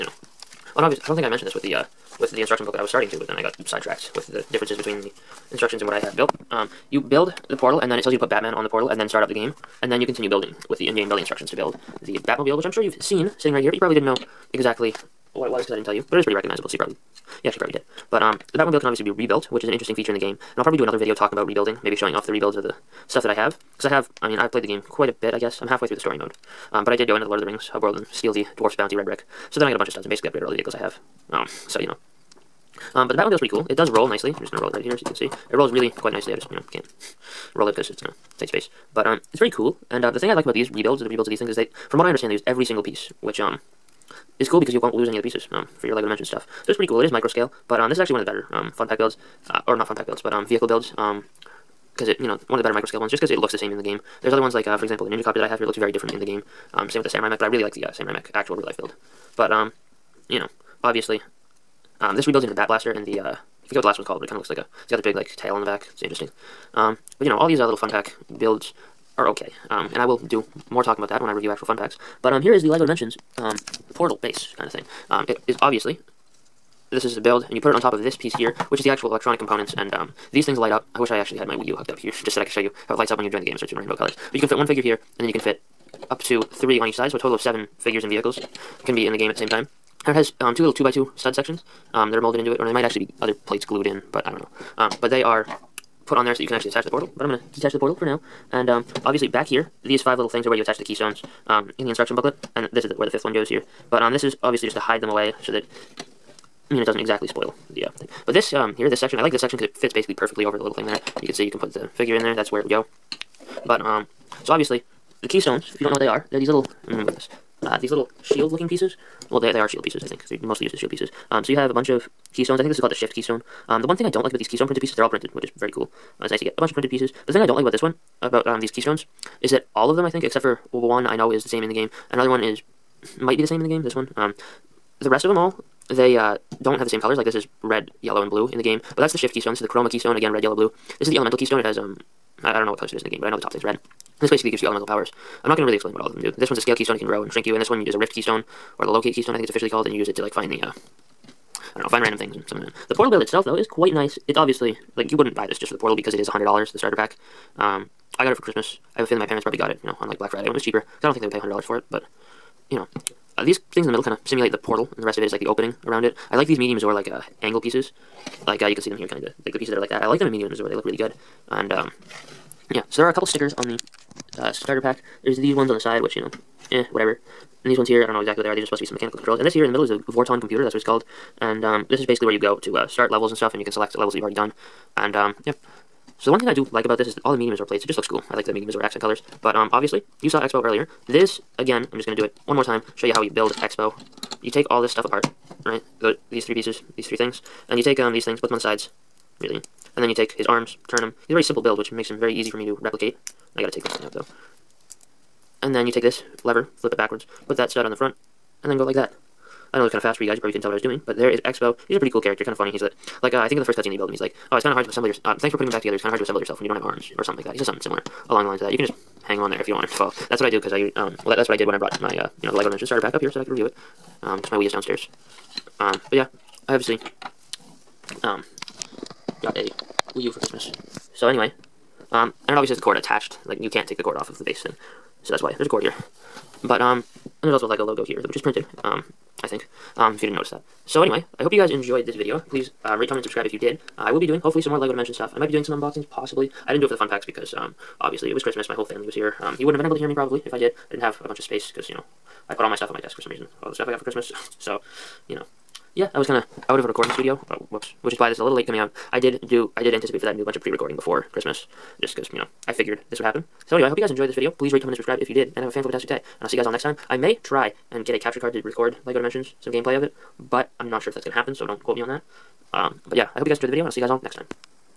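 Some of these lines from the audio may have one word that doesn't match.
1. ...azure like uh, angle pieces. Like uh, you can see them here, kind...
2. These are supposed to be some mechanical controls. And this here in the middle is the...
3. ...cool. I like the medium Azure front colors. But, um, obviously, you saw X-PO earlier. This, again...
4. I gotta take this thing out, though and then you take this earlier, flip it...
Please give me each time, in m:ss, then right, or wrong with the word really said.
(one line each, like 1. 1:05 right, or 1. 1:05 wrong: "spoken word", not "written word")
1. 2:46 right
2. 2:58 right
3. 3:08 wrong: "accent", not "front"
4. 3:23 wrong: "lever", not "earlier".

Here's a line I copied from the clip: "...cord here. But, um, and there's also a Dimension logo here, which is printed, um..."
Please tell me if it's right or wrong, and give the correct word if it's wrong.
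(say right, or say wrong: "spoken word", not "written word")
wrong: "Lego", not "Dimension".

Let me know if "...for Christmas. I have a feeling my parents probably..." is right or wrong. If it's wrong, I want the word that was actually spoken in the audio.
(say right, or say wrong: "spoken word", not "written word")
right.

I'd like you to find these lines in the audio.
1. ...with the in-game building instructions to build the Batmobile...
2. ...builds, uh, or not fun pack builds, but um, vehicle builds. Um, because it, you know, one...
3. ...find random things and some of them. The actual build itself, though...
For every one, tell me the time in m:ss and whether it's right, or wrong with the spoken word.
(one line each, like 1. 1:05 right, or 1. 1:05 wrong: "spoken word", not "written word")
1. 0:10 right
2. 0:48 right
3. 2:31 wrong: "portal", not "actual".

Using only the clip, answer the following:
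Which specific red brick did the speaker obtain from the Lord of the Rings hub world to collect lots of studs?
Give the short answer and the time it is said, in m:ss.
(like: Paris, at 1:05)
Dwarf's Bounty, at 0:28.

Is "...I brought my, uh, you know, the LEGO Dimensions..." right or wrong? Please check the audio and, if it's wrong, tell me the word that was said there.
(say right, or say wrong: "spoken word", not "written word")
right.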